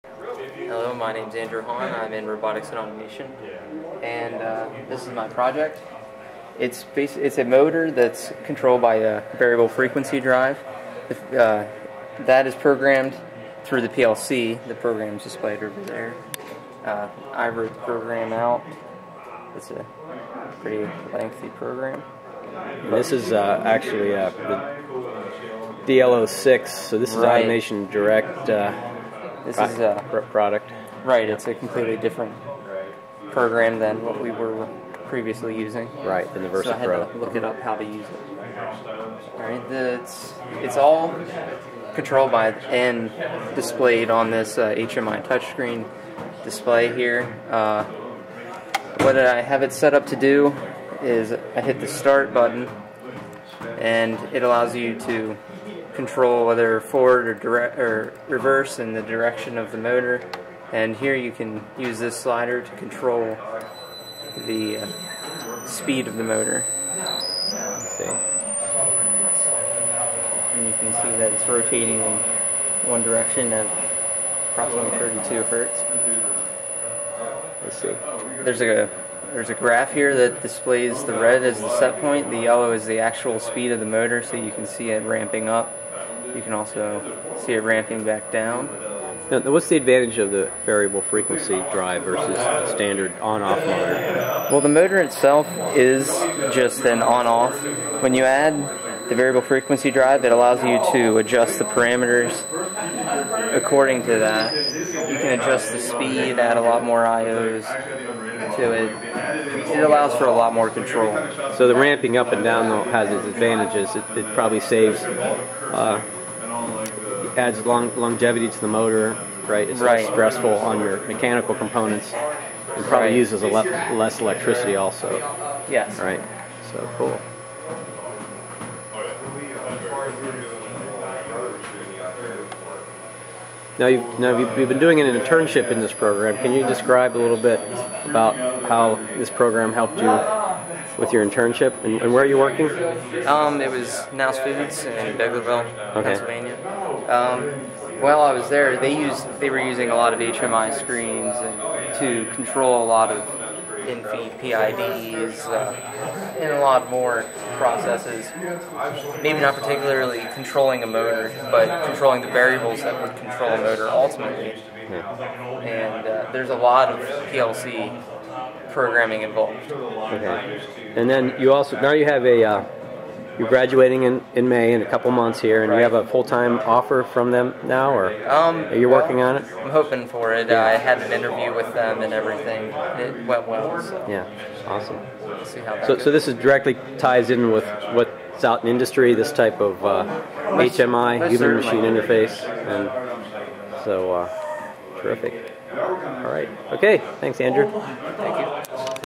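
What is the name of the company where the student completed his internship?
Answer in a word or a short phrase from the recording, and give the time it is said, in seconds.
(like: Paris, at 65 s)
Knouse Foods, at 144 s.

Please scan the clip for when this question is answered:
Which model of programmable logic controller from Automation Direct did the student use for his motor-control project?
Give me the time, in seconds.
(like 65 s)
25 s.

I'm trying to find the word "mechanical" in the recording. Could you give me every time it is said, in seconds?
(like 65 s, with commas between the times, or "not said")
121 s.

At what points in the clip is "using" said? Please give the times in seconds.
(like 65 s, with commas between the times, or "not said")
35 s, 149 s.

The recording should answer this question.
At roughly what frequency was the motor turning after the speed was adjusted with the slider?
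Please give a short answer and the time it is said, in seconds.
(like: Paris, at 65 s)
32 hertz, at 74 s.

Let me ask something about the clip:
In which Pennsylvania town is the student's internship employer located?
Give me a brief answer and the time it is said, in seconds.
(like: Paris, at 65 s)
Biglerville, at 145 s.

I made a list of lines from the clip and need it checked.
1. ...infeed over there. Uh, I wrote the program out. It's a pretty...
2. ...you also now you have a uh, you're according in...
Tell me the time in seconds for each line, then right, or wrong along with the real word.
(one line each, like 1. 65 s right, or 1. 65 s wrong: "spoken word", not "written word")
1. 15 s wrong: "displayed", not "infeed"
2. 171 s wrong: "graduating", not "according".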